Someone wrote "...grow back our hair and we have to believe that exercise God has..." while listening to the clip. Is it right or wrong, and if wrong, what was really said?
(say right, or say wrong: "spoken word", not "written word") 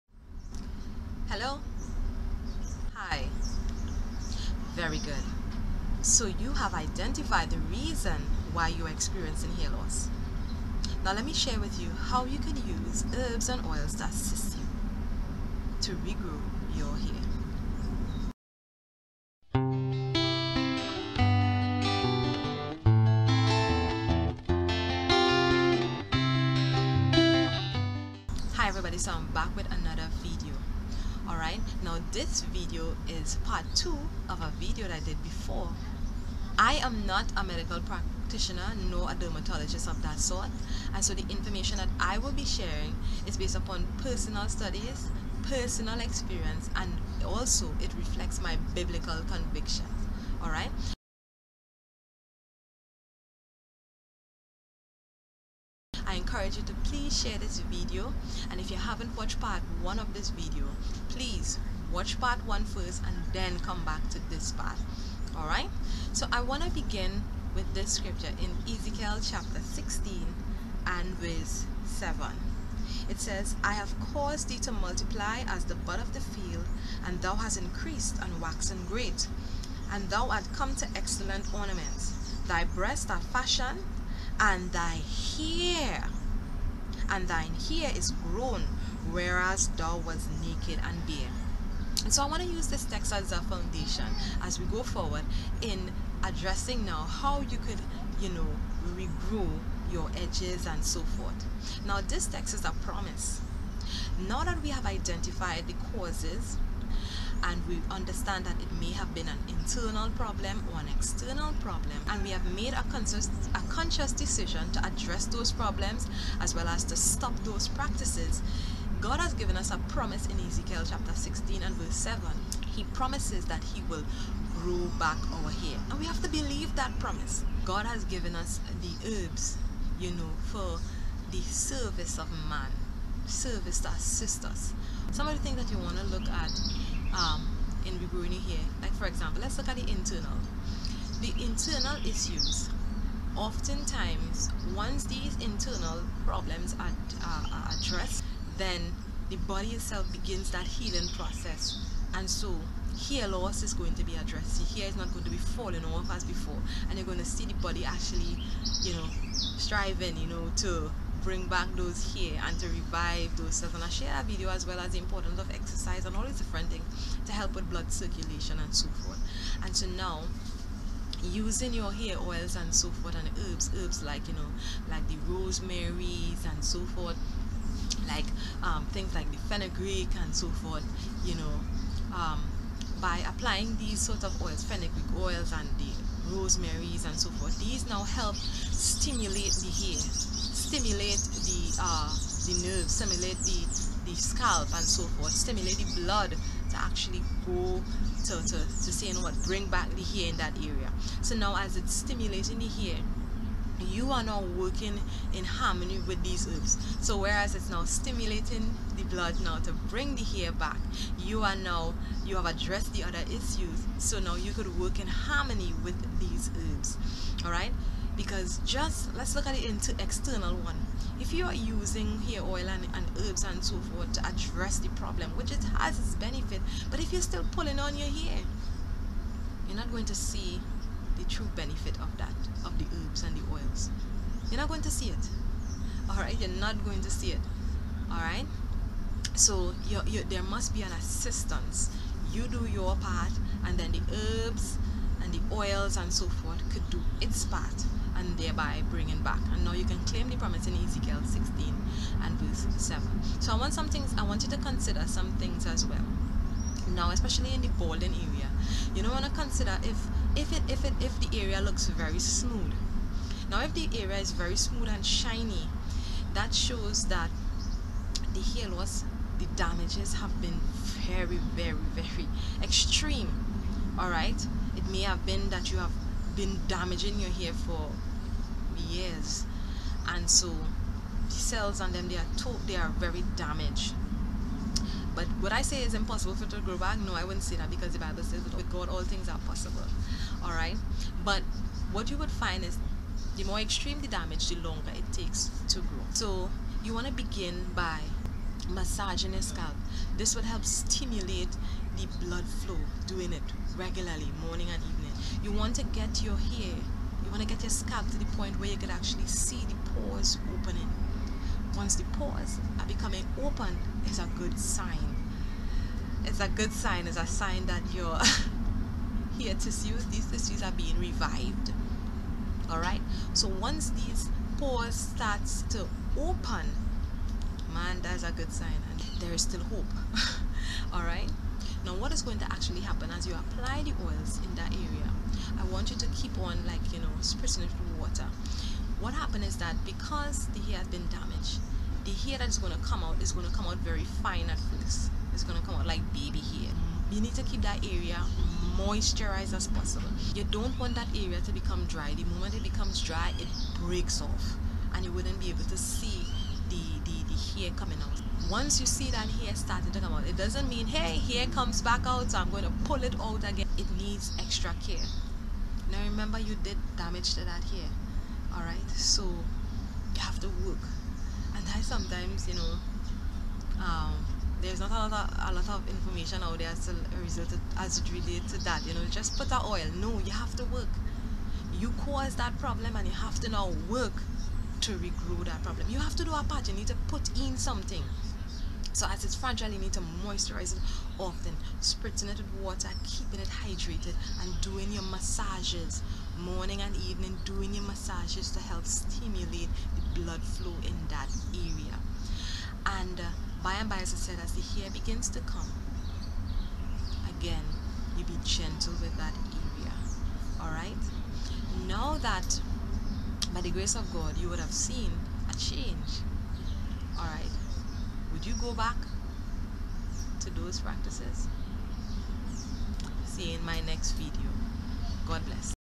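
wrong: "promise", not "exercise".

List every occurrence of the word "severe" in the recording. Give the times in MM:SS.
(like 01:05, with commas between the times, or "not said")
not said.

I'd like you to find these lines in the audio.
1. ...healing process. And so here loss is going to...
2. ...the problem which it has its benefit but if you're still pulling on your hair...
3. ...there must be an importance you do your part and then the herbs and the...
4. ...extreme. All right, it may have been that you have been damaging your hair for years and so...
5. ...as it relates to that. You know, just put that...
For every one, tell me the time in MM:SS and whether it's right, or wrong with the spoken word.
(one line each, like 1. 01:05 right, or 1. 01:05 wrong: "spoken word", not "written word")
1. 02:30 right
2. 03:44 right
3. 04:00 wrong: "assistance", not "importance"
4. 04:32 right
5. 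06:17 right.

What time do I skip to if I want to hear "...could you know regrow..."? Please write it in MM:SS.
01:37.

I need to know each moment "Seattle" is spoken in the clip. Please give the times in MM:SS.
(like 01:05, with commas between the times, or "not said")
not said.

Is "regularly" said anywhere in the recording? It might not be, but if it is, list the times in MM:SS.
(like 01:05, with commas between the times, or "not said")
05:03.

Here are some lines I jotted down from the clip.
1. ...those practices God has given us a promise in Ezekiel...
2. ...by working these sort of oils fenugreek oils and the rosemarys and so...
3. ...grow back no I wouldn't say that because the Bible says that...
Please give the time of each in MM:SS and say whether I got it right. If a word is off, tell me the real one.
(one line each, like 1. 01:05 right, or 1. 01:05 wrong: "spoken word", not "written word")
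1. 01:57 right
2. 03:02 wrong: "applying", not "working"
3. 04:46 right.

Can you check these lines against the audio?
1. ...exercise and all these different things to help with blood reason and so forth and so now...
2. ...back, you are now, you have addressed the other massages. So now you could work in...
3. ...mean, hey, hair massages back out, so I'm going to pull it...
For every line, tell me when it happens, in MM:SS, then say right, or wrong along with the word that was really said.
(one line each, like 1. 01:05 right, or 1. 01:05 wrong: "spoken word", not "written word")
1. 02:45 wrong: "circulation", not "reason"
2. 03:30 wrong: "issues", not "massages"
3. 06:00 wrong: "comes", not "massages".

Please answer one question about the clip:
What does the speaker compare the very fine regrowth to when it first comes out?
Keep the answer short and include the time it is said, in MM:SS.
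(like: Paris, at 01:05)
Baby hair, at 05:46.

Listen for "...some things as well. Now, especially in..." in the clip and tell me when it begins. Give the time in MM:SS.
04:15.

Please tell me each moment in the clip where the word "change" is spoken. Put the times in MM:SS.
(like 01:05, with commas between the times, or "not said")
06:55.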